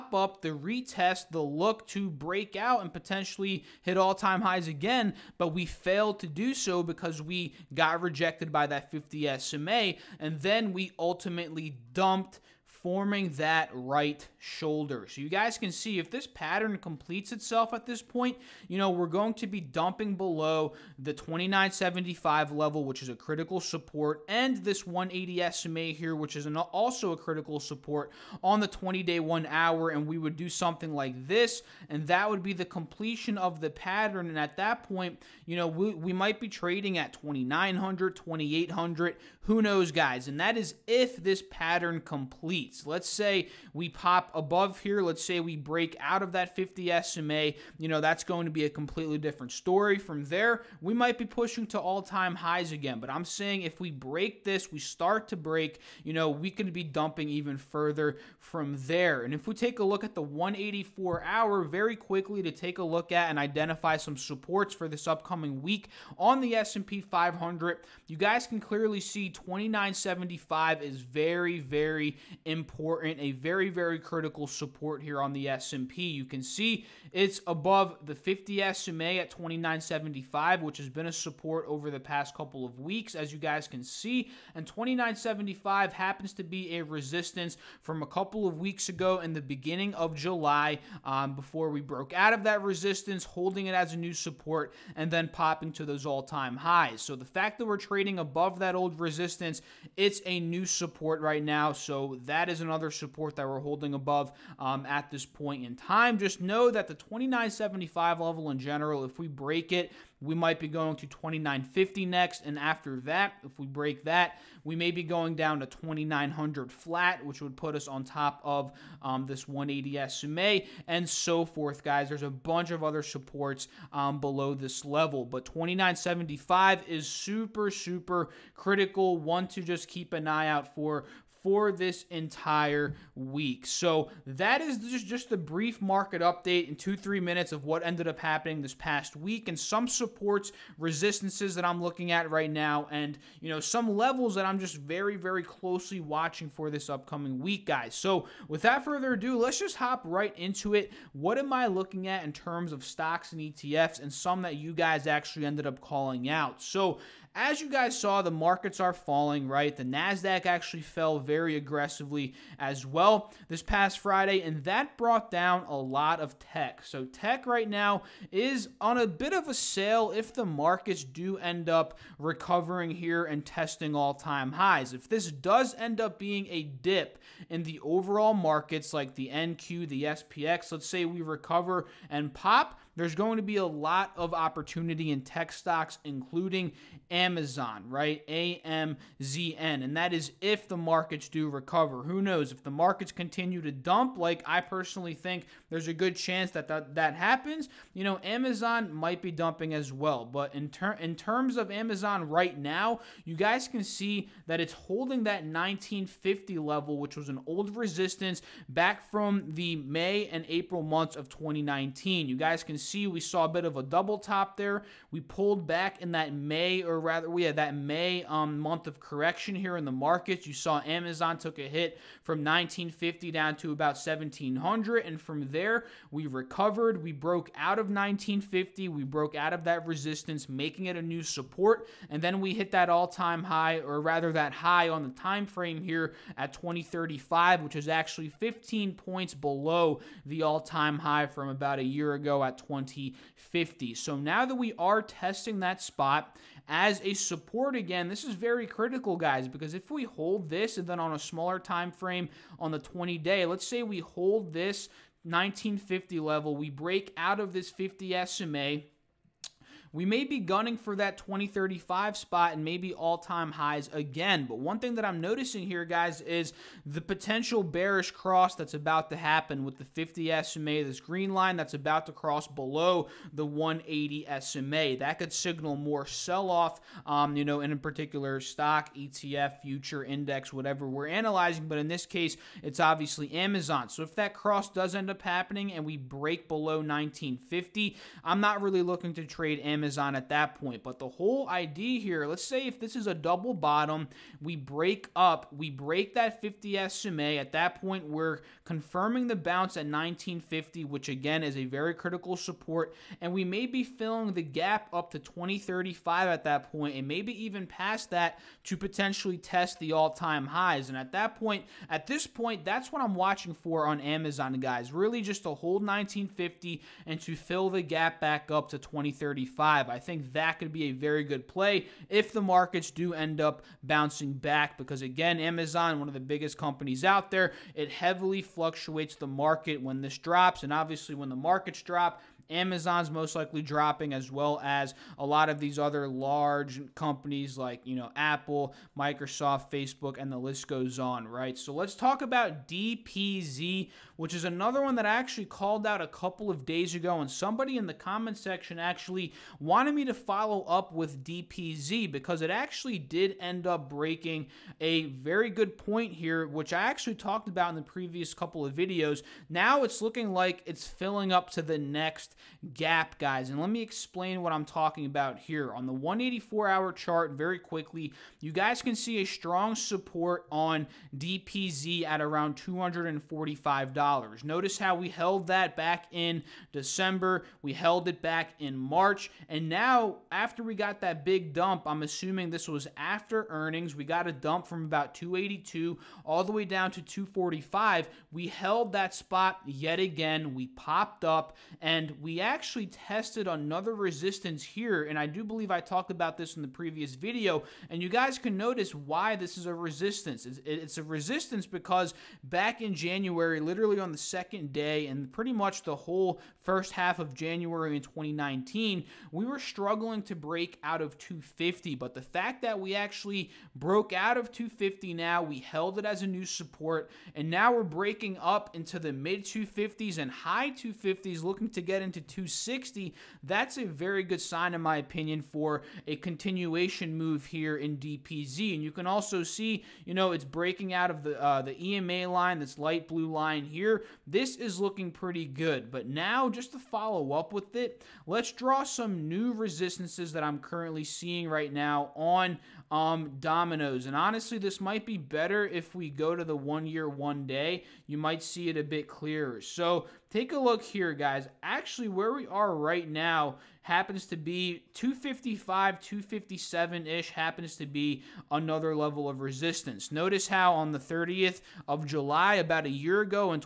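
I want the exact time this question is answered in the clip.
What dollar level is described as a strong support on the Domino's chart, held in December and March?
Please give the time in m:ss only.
6:12.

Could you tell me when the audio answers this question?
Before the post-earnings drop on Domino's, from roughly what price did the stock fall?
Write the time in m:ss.
6:25.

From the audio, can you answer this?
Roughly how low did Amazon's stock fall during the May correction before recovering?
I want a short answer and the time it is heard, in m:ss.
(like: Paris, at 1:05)
1700, at 3:43.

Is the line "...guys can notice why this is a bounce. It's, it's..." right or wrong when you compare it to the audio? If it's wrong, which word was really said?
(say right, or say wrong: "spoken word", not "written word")
wrong: "resistance", not "bounce".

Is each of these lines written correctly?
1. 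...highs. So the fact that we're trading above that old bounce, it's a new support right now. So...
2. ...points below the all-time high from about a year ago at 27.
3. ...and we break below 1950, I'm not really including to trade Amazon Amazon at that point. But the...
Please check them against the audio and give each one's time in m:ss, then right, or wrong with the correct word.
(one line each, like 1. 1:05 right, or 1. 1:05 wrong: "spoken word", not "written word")
1. 1:36 wrong: "resistance", not "bounce"
2. 3:58 wrong: "20", not "27"
3. 4:45 wrong: "looking", not "including".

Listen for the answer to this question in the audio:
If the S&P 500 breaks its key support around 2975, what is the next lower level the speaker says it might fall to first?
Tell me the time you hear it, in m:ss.
1:51.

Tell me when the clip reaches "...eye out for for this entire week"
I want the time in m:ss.
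2:10.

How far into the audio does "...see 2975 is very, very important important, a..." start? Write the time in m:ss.
1:09.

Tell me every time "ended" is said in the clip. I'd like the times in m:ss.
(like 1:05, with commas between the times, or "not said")
2:17, 2:35.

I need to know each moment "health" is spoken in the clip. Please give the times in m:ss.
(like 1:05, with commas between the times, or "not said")
not said.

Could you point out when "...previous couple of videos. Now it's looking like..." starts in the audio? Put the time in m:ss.
5:57.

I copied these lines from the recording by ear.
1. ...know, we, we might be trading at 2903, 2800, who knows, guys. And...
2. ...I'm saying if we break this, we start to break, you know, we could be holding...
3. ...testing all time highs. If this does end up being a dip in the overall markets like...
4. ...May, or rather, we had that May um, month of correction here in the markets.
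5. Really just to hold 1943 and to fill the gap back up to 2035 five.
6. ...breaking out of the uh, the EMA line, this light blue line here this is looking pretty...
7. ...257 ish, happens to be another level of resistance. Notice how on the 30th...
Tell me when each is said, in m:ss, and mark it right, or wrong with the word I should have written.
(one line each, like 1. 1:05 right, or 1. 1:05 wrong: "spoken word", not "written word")
1. 0:35 wrong: "2900", not "2903"
2. 0:53 wrong: "dumping", not "holding"
3. 2:53 right
4. 3:36 right
5. 5:14 wrong: "1950", not "1943"
6. 7:10 right
7. 7:35 right.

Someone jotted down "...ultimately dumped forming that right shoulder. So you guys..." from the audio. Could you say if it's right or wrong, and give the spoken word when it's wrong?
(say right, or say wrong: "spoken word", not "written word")
right.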